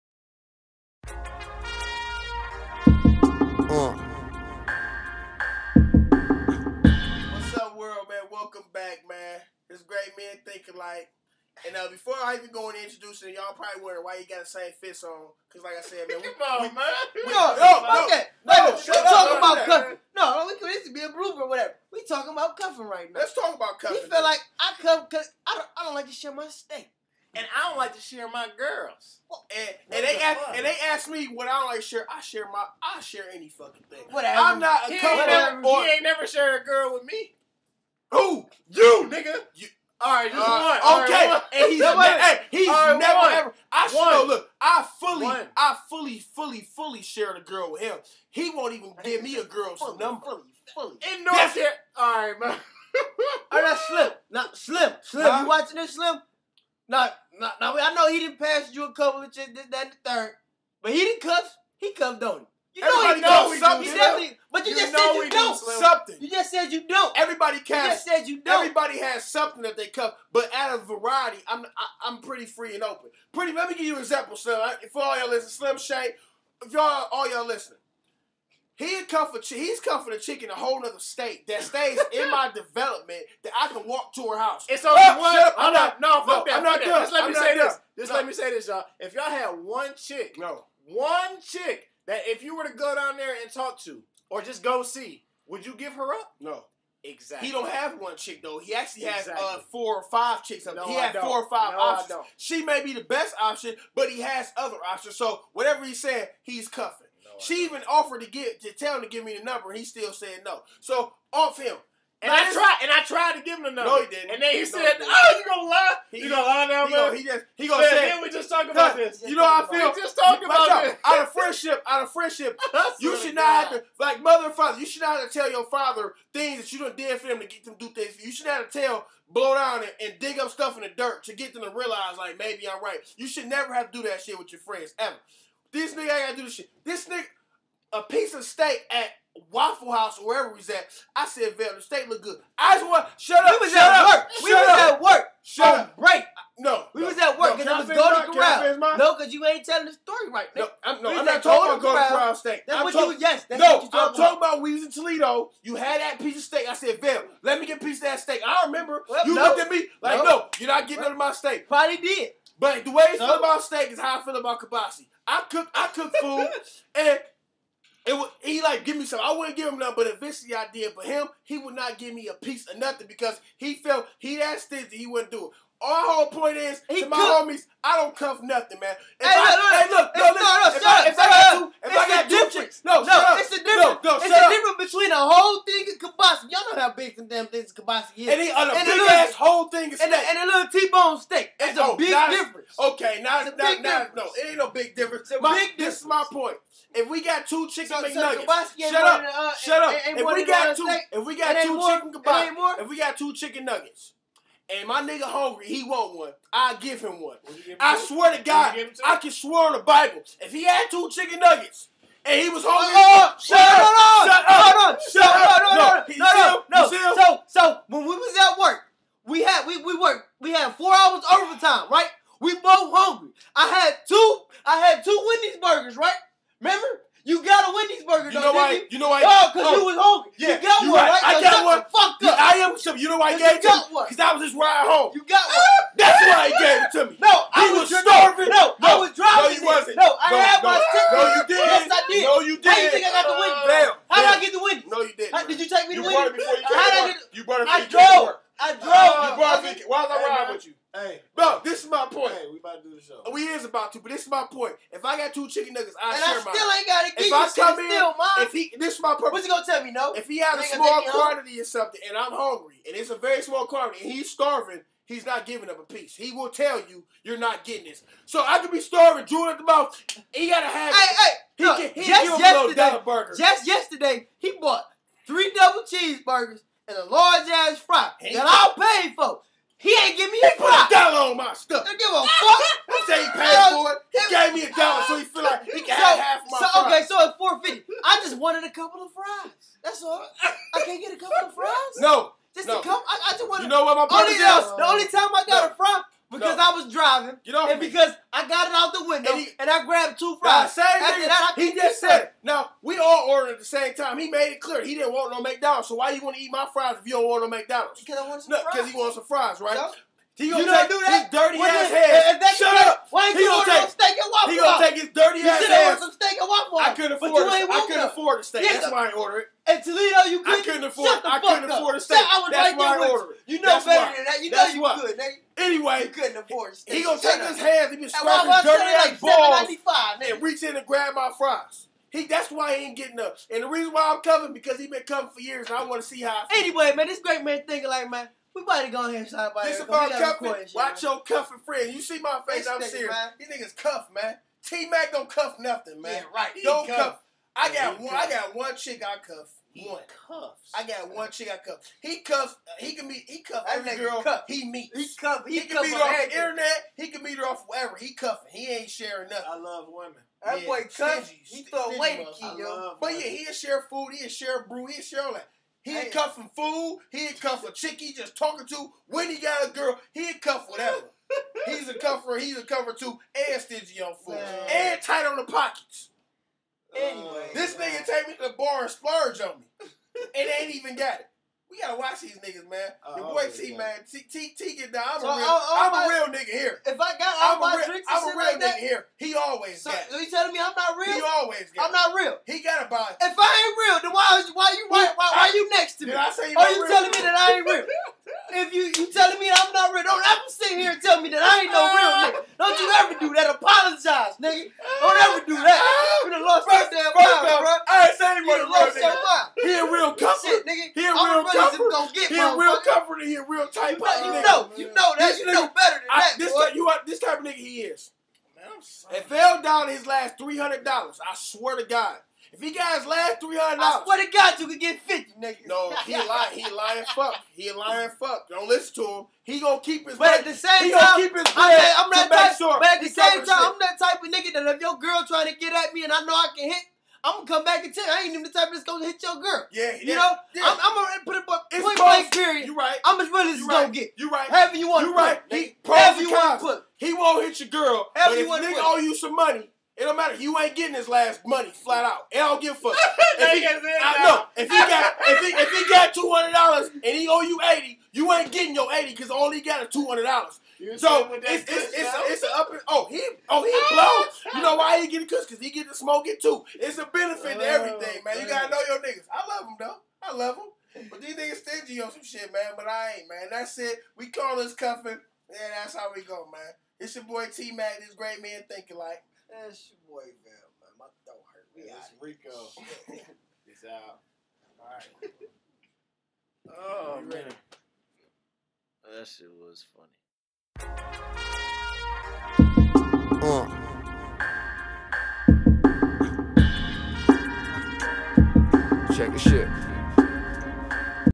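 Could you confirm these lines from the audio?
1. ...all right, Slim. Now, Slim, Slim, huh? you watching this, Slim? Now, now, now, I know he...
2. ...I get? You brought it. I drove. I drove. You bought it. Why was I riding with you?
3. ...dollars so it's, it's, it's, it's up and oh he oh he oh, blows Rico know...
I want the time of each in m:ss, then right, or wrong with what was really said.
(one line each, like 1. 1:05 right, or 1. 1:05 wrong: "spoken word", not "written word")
1. 0:53 right
2. 4:06 wrong: "brought", not "bought"
3. 7:40 wrong: "You", not "Rico".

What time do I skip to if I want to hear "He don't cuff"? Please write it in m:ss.
5:46.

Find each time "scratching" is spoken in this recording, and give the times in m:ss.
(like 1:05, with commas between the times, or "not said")
5:28.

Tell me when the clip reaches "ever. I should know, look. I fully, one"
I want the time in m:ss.
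0:43.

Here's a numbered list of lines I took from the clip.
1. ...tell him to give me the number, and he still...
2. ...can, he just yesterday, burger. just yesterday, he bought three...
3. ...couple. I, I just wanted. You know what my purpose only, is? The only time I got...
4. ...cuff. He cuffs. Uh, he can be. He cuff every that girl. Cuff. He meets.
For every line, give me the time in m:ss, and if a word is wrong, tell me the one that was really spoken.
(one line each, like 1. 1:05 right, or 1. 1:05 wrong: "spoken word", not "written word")
1. 1:48 right
2. 4:31 right
3. 4:52 right
4. 5:51 right.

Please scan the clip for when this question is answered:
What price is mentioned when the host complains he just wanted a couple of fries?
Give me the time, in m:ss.
4:47.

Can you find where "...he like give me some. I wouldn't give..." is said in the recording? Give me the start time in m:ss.
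2:48.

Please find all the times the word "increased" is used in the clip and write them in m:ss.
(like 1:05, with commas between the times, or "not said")
not said.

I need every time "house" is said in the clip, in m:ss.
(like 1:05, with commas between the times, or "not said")
1:24, 2:19.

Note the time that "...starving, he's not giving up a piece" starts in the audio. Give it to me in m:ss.
4:24.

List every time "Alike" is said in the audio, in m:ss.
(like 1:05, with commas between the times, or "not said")
5:37, 7:58.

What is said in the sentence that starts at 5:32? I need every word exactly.
He that's why he ain't getting up.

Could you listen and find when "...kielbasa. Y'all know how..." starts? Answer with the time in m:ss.
3:05.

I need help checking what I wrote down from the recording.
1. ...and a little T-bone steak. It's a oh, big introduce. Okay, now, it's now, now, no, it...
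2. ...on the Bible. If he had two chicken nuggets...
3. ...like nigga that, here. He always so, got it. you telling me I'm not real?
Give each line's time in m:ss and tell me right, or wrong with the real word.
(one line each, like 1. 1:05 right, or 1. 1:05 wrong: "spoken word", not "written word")
1. 3:10 wrong: "difference", not "introduce"
2. 3:29 right
3. 6:28 right.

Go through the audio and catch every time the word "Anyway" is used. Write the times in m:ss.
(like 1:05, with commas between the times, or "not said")
5:25, 5:36, 6:16.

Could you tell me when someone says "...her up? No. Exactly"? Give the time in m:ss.
1:35.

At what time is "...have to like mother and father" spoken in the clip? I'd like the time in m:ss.
2:03.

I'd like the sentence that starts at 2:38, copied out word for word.
I remember well, you no, looked at me like, no, you're not getting none of my steak.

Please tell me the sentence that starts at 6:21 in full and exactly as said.
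We gotta watch these niggas, man.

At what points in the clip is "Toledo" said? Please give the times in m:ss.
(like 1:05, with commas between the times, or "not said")
2:34, 5:19.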